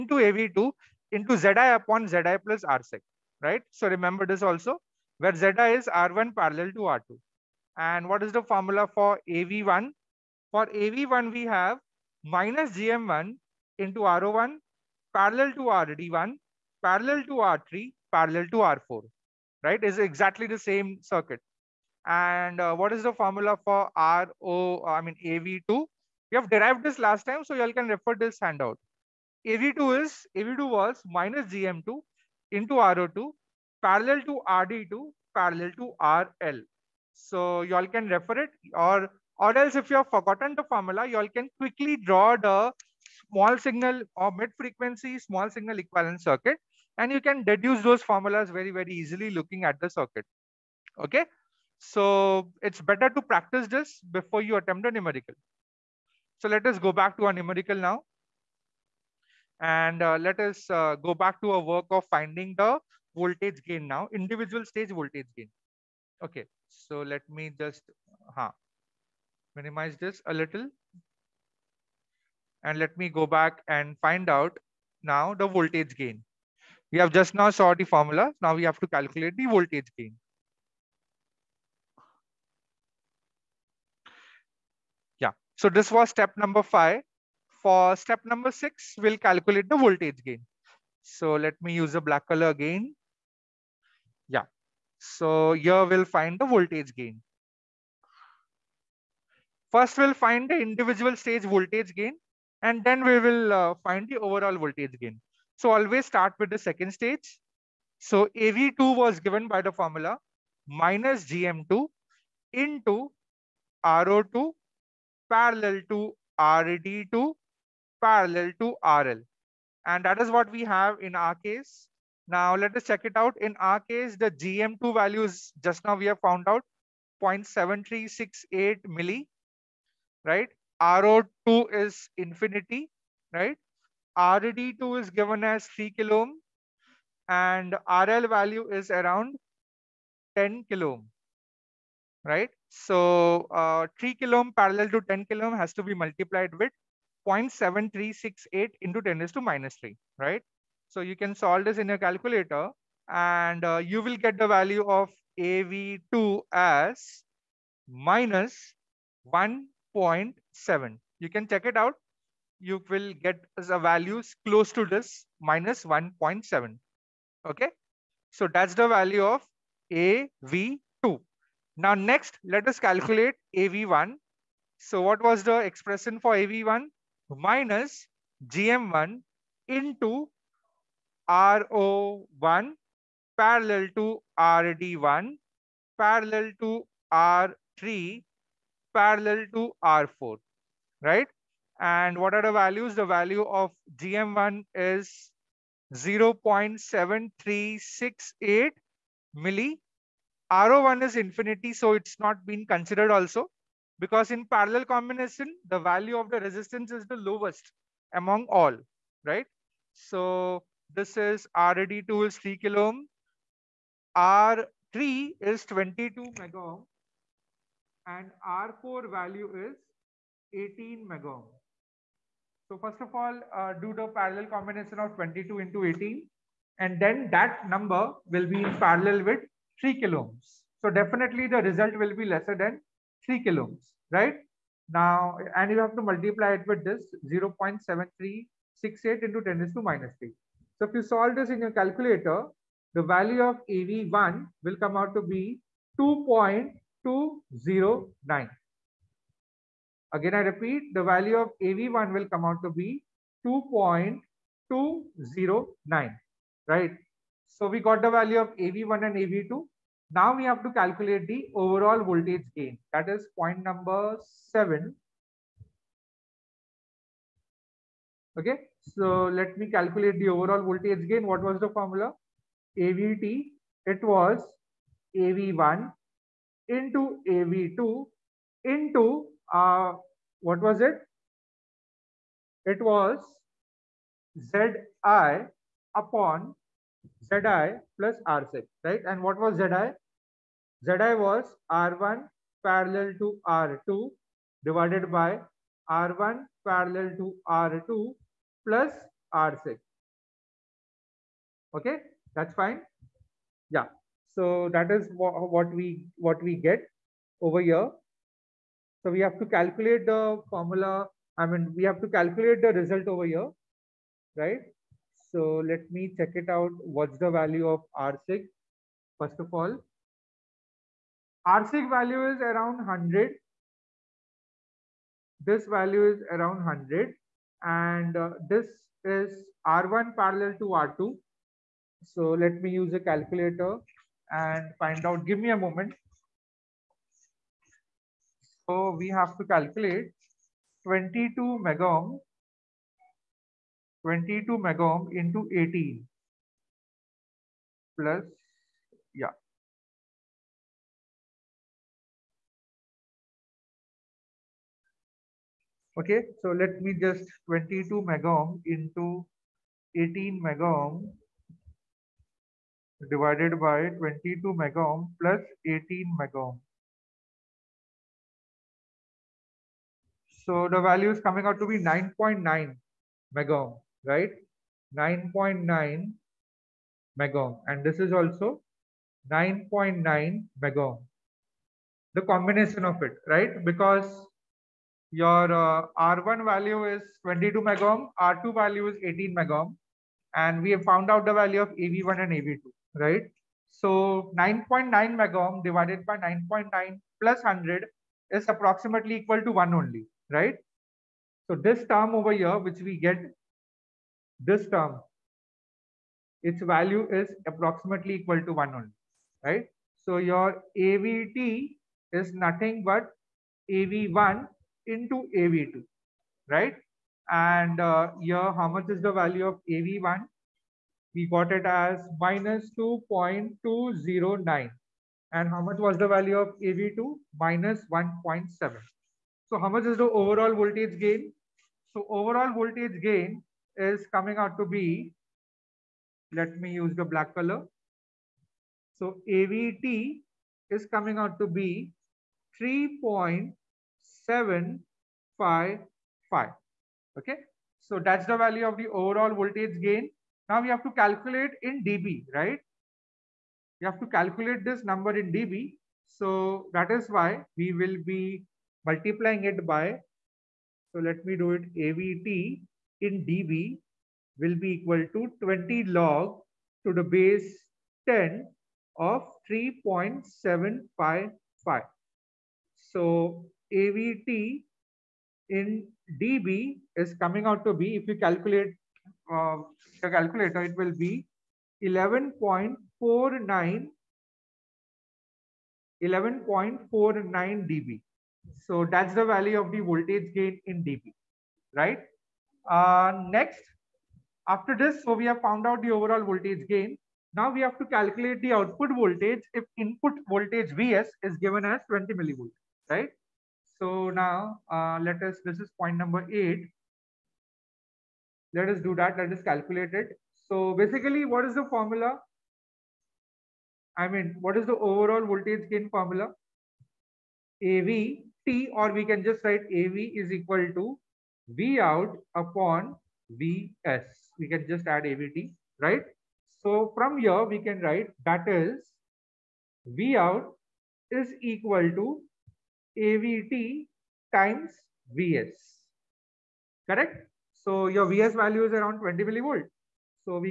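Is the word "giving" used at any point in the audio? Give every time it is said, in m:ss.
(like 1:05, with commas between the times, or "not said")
not said.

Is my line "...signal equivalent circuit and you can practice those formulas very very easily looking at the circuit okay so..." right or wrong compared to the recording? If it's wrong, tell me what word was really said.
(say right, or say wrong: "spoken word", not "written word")
wrong: "deduce", not "practice".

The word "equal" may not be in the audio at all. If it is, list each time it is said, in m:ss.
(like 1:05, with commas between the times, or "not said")
6:39, 6:48, 7:44, 8:40, 8:51.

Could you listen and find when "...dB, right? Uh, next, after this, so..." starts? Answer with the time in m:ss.
8:10.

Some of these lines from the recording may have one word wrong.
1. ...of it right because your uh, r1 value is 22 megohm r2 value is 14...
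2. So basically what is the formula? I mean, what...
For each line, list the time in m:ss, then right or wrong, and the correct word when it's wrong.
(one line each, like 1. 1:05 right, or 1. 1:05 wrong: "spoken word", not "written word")
1. 6:22 wrong: "18", not "14"
2. 8:30 right.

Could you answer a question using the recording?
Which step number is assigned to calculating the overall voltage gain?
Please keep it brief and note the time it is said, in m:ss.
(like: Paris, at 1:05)
7, at 4:23.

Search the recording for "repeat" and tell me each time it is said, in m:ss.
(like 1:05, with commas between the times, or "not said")
4:10.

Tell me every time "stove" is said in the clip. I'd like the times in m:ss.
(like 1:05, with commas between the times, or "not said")
not said.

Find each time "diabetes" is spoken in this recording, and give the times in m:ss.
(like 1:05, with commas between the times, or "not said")
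not said.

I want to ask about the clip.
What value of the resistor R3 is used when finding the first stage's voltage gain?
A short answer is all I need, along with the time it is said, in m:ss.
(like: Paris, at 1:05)
22 mega ohm, at 3:34.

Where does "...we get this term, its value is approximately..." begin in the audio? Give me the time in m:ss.
6:42.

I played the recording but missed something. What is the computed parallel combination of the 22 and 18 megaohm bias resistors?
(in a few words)
9.9 megaohm.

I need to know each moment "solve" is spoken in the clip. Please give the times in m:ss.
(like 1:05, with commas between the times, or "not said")
2:31, 4:01.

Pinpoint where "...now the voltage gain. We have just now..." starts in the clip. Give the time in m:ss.
1:15.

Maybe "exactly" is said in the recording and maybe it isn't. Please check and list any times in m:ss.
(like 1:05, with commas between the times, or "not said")
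0:19.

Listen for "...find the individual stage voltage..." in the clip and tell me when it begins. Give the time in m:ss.
1:40.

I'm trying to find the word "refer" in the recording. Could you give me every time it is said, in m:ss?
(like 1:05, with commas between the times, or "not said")
0:27, 0:38.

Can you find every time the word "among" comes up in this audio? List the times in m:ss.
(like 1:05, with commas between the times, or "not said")
3:28.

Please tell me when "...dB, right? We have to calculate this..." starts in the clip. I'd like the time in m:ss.
7:31.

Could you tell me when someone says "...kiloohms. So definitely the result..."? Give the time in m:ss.
3:49.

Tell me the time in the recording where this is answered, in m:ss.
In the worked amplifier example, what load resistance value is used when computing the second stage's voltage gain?
2:20.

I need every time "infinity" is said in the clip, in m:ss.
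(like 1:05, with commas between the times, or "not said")
2:12, 3:21.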